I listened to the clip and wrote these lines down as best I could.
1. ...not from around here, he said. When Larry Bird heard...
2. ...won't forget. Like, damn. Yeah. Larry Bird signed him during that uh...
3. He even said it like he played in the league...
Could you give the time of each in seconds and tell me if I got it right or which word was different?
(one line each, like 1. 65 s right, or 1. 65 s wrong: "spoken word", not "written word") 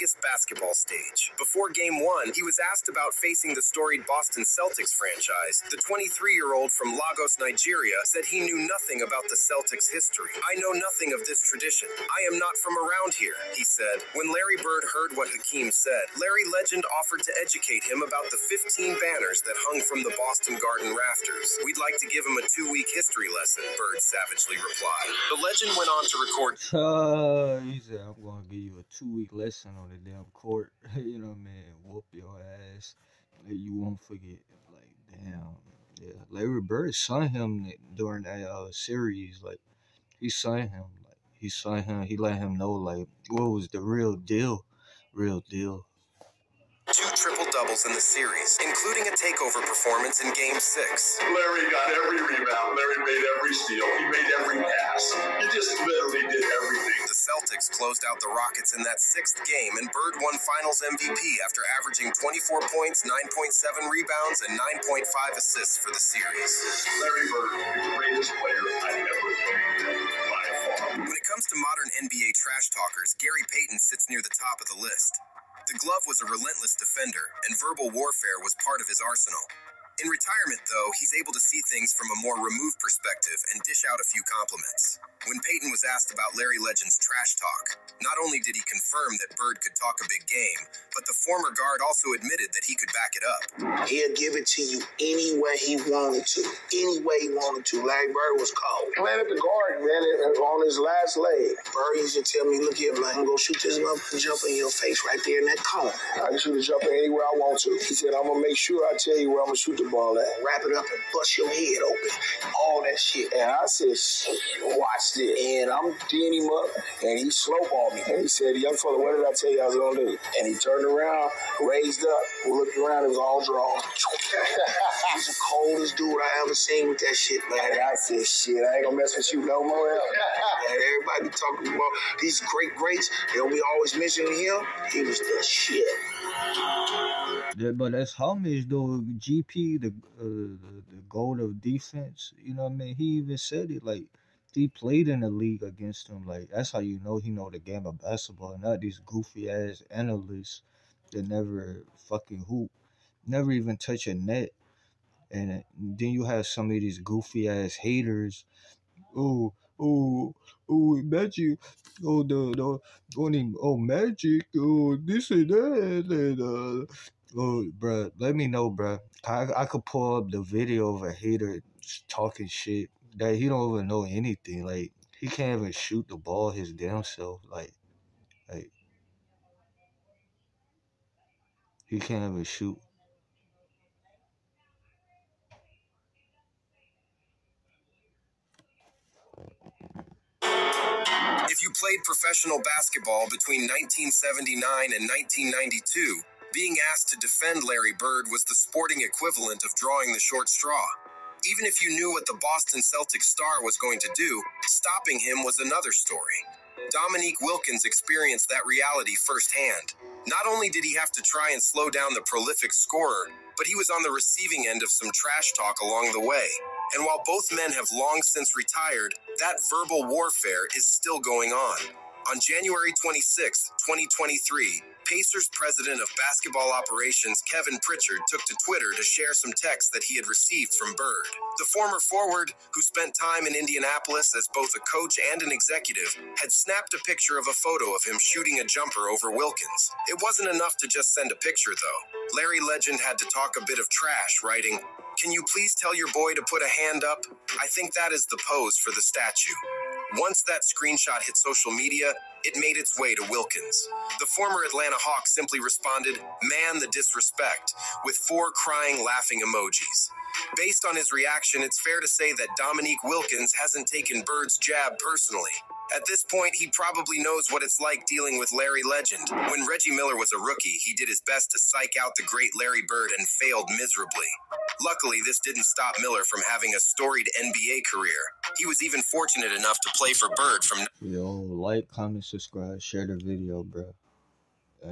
1. 12 s right
2. 33 s right
3. 142 s right.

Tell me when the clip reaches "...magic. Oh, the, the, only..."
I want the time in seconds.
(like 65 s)
161 s.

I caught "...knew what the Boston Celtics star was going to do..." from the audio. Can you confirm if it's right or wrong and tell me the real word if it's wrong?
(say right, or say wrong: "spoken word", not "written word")
right.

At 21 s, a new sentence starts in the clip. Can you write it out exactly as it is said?
We'd like to give him a two week history lesson, Bird savagely replied.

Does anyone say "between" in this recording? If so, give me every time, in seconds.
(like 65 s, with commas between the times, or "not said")
193 s.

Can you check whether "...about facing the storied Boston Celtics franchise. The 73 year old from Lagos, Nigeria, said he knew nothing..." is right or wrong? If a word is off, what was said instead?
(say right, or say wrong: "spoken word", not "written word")
wrong: "23", not "73".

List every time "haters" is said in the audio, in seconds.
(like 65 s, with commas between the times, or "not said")
157 s, 171 s.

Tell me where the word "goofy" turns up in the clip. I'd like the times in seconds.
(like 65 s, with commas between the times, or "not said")
149 s, 156 s.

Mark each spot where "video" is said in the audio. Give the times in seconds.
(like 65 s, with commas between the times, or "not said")
170 s, 283 s.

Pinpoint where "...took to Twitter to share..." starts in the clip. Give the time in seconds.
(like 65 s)
228 s.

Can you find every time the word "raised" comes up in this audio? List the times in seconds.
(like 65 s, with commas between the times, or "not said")
121 s.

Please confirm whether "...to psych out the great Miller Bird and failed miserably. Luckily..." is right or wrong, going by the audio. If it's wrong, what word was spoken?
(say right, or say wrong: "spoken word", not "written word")
wrong: "Larry", not "Miller".